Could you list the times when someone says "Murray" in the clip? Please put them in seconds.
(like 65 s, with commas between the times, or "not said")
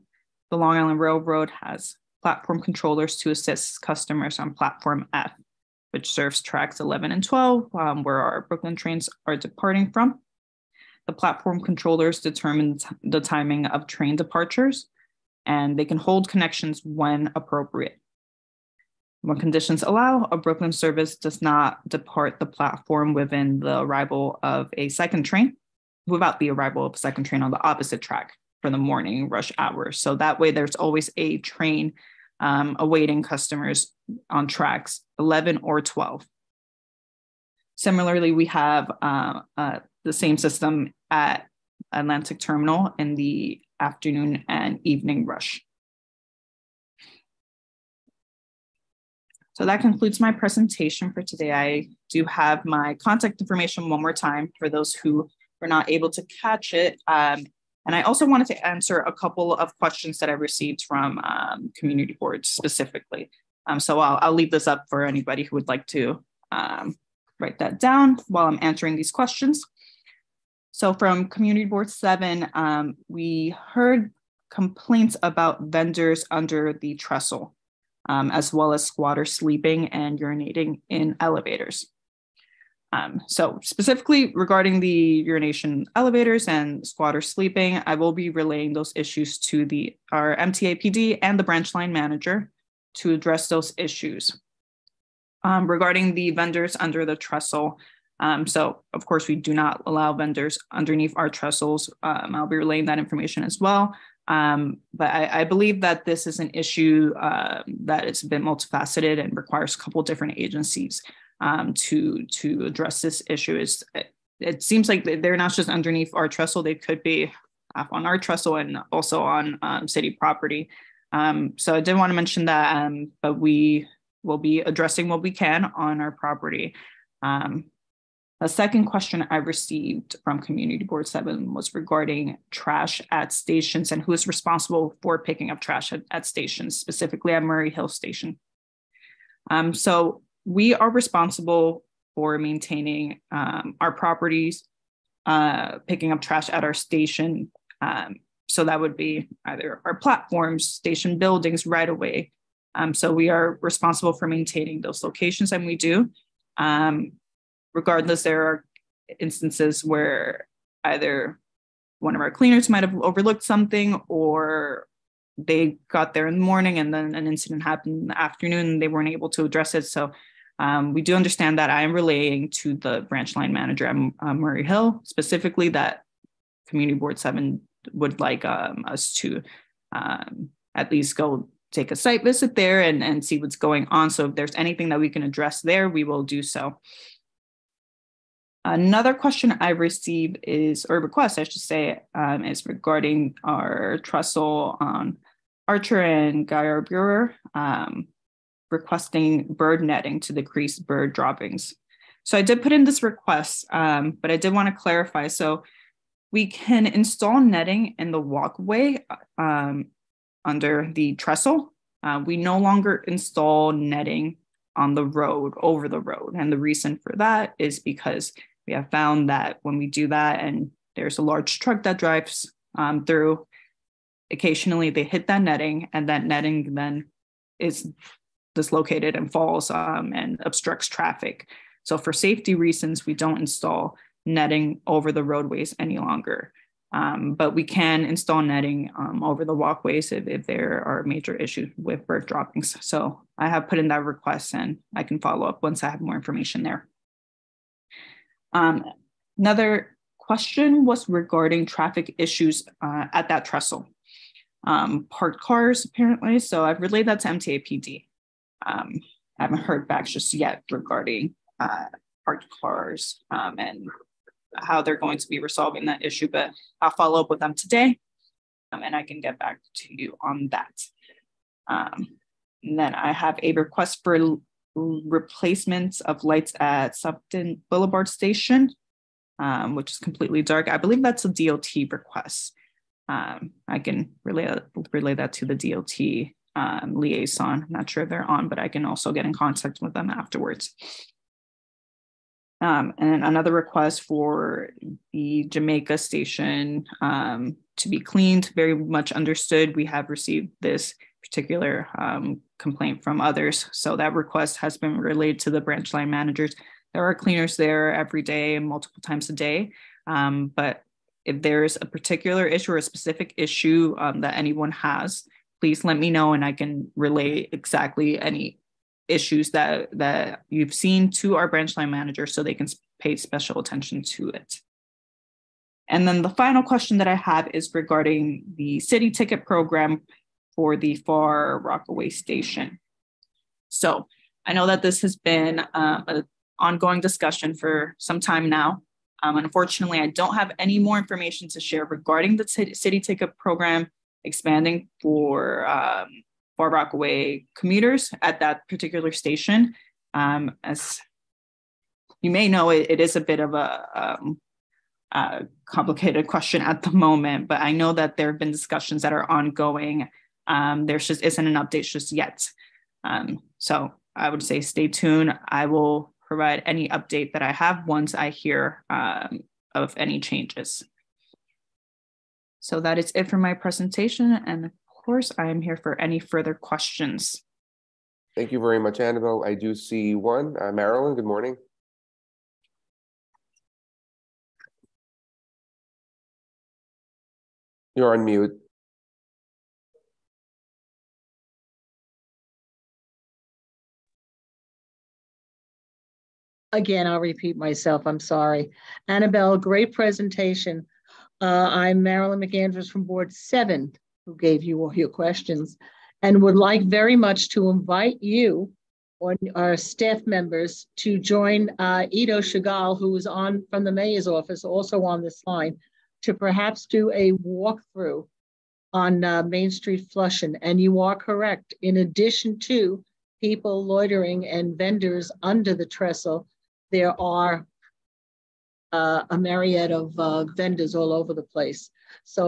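137 s, 174 s.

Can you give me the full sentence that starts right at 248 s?
Um, another question was regarding traffic issues uh, at that trestle.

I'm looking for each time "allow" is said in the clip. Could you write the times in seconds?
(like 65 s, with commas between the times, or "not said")
19 s, 99 s.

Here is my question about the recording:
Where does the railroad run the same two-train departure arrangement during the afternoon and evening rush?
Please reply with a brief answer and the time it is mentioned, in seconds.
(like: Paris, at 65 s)
Atlantic Terminal, at 41 s.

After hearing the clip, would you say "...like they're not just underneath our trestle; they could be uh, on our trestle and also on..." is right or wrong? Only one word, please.
right.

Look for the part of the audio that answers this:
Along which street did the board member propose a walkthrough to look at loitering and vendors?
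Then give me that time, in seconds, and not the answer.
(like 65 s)
419 s.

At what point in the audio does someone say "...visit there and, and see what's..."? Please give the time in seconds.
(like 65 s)
182 s.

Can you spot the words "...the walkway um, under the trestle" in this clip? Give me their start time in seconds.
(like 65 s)
208 s.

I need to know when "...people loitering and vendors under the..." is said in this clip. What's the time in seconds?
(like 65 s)
423 s.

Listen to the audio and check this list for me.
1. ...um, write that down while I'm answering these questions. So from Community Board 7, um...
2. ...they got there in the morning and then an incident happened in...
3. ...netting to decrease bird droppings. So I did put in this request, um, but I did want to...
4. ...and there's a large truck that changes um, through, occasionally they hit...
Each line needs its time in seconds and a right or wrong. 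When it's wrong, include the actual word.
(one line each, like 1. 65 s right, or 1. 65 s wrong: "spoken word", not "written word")
1. 66 s right
2. 165 s right
3. 199 s right
4. 220 s wrong: "drives", not "changes".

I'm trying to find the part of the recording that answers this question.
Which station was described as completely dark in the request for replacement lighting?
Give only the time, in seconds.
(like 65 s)
276 s.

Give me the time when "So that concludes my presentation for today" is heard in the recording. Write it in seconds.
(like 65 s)
49 s.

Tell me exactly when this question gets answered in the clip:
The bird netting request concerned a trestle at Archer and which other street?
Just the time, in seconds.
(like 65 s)
196 s.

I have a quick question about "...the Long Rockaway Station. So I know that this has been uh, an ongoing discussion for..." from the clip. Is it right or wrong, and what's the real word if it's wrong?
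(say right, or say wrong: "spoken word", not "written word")
wrong: "Far", not "Long".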